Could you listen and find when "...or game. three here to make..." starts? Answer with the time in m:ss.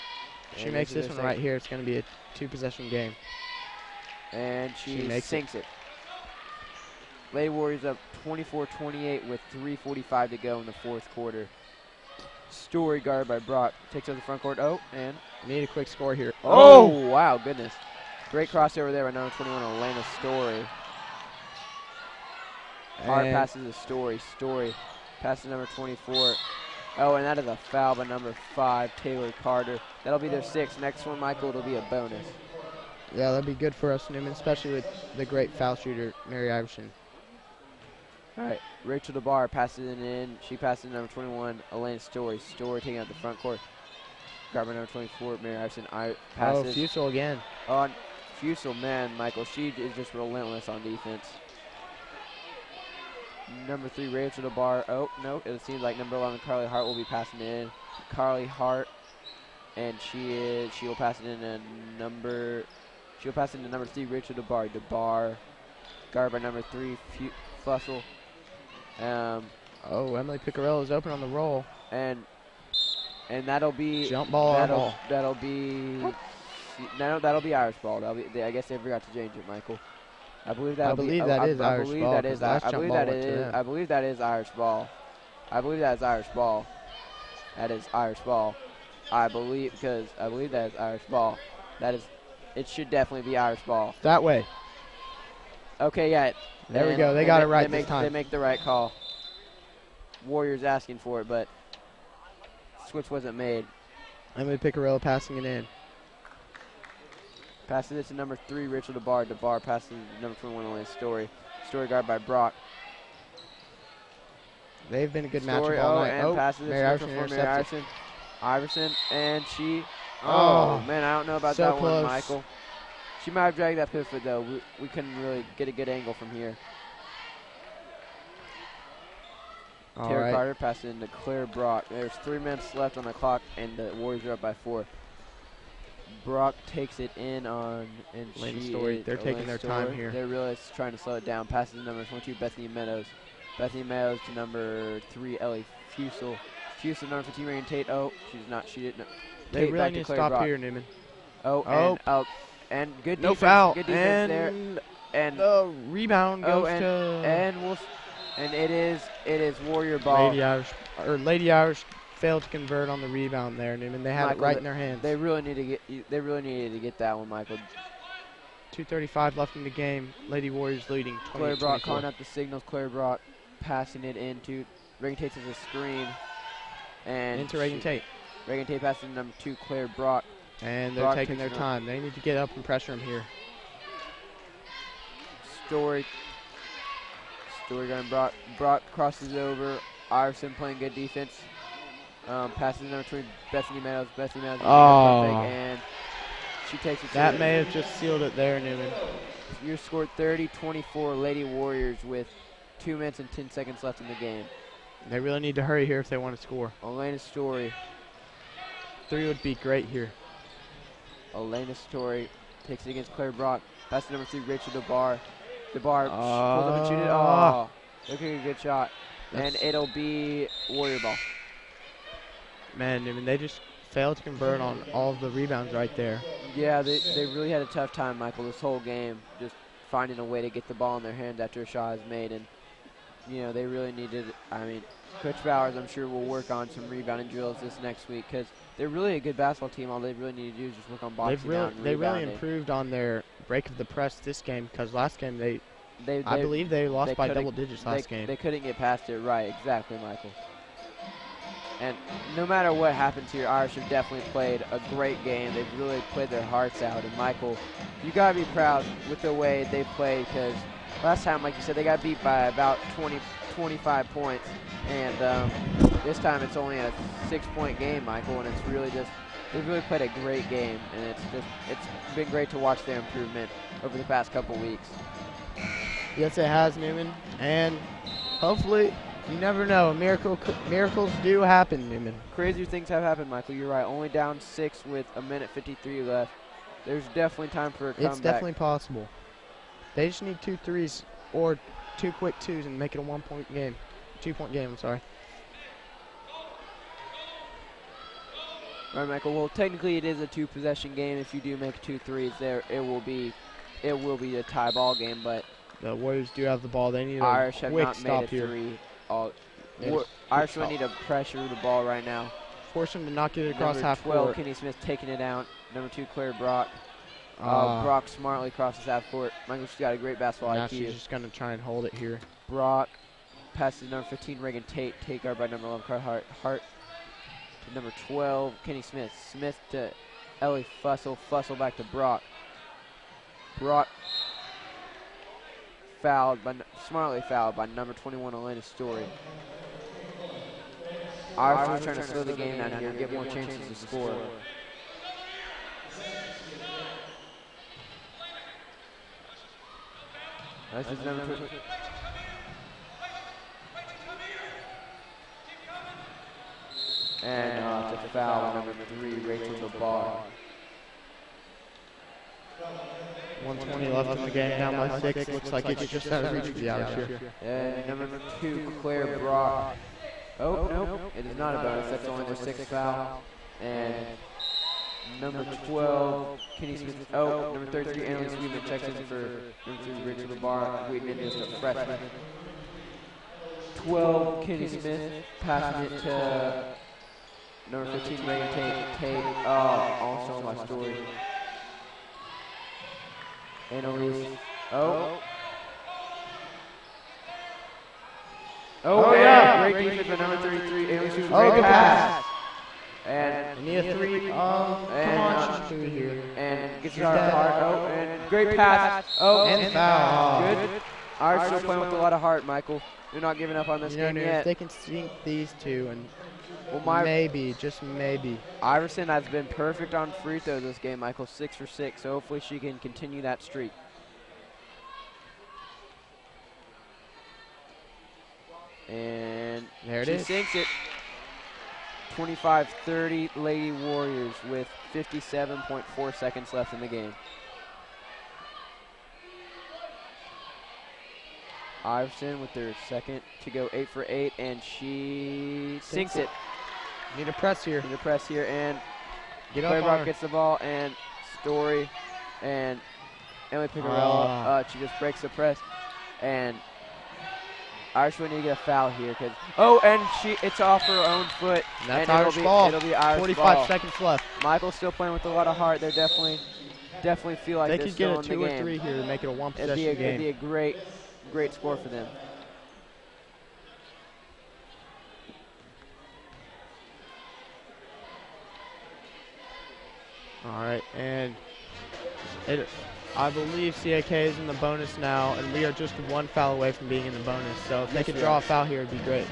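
7:48.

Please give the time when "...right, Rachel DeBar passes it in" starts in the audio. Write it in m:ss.
0:38.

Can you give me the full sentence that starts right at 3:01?
They need to get up and pressure him here.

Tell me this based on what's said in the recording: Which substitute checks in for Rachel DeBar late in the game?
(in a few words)
Annalise Weedman.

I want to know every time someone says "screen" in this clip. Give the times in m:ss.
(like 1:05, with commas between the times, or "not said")
2:55.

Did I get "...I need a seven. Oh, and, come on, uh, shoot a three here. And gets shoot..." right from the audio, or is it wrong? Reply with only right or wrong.
wrong.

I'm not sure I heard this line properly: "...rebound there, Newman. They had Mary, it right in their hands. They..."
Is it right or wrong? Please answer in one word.
wrong.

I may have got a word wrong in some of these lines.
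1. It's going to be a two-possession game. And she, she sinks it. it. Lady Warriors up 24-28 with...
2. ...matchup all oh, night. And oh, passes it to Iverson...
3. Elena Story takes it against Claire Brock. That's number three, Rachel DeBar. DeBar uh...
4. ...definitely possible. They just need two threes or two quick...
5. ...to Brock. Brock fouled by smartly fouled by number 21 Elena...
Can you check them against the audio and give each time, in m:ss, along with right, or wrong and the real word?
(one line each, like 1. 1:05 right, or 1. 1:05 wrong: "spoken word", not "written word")
1. 0:01 right
2. 1:55 right
3. 3:31 right
4. 4:48 right
5. 5:31 right.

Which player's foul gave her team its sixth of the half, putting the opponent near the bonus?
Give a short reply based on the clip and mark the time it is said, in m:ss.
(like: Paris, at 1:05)
Taylor Carter, at 0:28.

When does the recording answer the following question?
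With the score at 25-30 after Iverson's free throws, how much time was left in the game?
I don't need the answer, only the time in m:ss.
7:14.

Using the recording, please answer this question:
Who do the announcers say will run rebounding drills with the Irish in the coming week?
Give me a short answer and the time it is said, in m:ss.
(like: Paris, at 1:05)
Coach Bowers, at 3:55.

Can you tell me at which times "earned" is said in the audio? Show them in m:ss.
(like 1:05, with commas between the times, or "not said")
not said.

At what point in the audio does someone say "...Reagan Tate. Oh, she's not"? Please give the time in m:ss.
2:27.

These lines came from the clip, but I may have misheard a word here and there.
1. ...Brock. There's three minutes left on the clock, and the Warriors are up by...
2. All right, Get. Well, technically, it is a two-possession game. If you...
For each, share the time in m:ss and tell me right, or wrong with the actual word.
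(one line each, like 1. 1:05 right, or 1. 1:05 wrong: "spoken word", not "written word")
1. 2:11 right
2. 4:58 wrong: "Michael", not "Get".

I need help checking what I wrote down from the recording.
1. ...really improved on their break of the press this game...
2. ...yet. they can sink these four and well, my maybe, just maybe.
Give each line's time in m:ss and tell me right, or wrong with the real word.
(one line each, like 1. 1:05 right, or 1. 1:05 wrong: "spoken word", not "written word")
1. 4:01 right
2. 6:54 wrong: "two", not "four".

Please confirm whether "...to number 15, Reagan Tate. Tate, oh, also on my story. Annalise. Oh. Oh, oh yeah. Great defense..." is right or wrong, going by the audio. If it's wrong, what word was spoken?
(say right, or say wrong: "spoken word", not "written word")
right.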